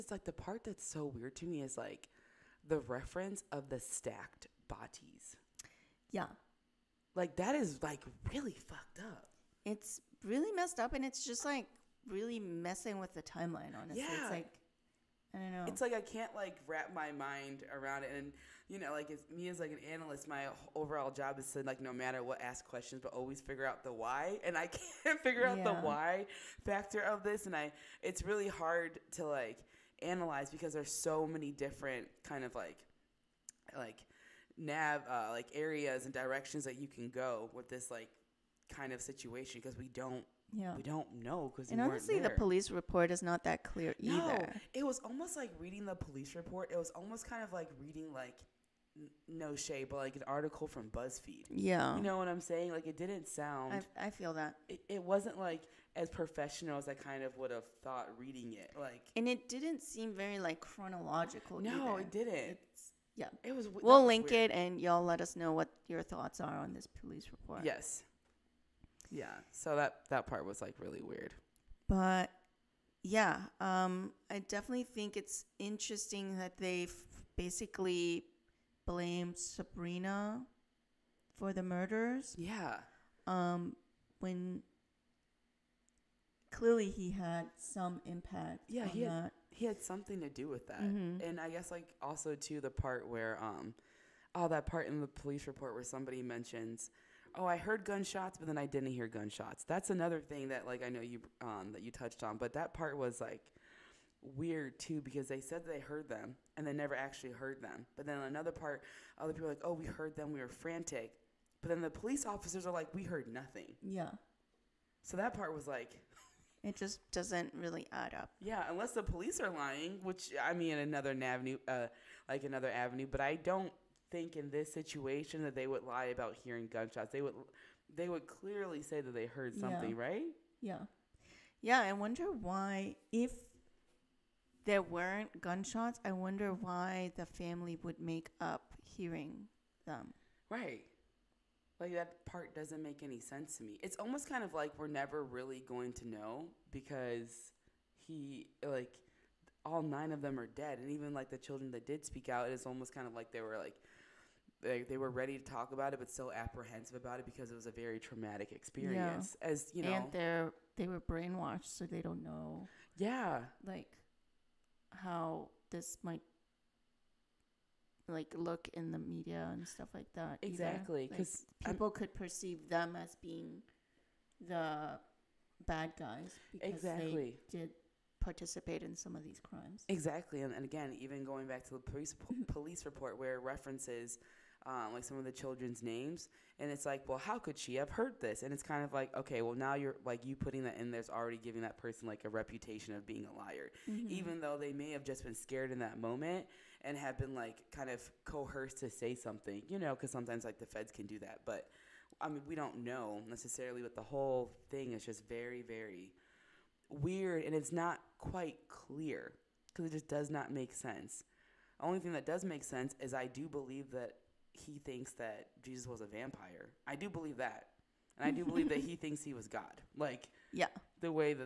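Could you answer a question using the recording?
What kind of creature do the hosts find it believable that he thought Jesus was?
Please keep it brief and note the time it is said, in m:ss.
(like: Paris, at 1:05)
a vampire, at 3:36.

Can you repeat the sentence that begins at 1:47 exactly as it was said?
But then another part other people like oh we heard them we were frantic.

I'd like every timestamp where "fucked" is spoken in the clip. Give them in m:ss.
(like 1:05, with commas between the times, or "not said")
0:08.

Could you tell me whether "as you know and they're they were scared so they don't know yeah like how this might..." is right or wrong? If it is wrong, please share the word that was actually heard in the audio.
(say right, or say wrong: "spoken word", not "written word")
wrong: "brainwashed", not "scared".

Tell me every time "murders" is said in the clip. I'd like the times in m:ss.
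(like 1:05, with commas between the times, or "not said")
1:21.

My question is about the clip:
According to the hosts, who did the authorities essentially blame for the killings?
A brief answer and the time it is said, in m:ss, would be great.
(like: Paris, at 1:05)
Sabrina, at 1:19.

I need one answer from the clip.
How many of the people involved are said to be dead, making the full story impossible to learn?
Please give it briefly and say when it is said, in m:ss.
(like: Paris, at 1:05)
9, at 2:29.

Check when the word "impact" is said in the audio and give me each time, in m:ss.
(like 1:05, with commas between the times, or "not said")
1:28.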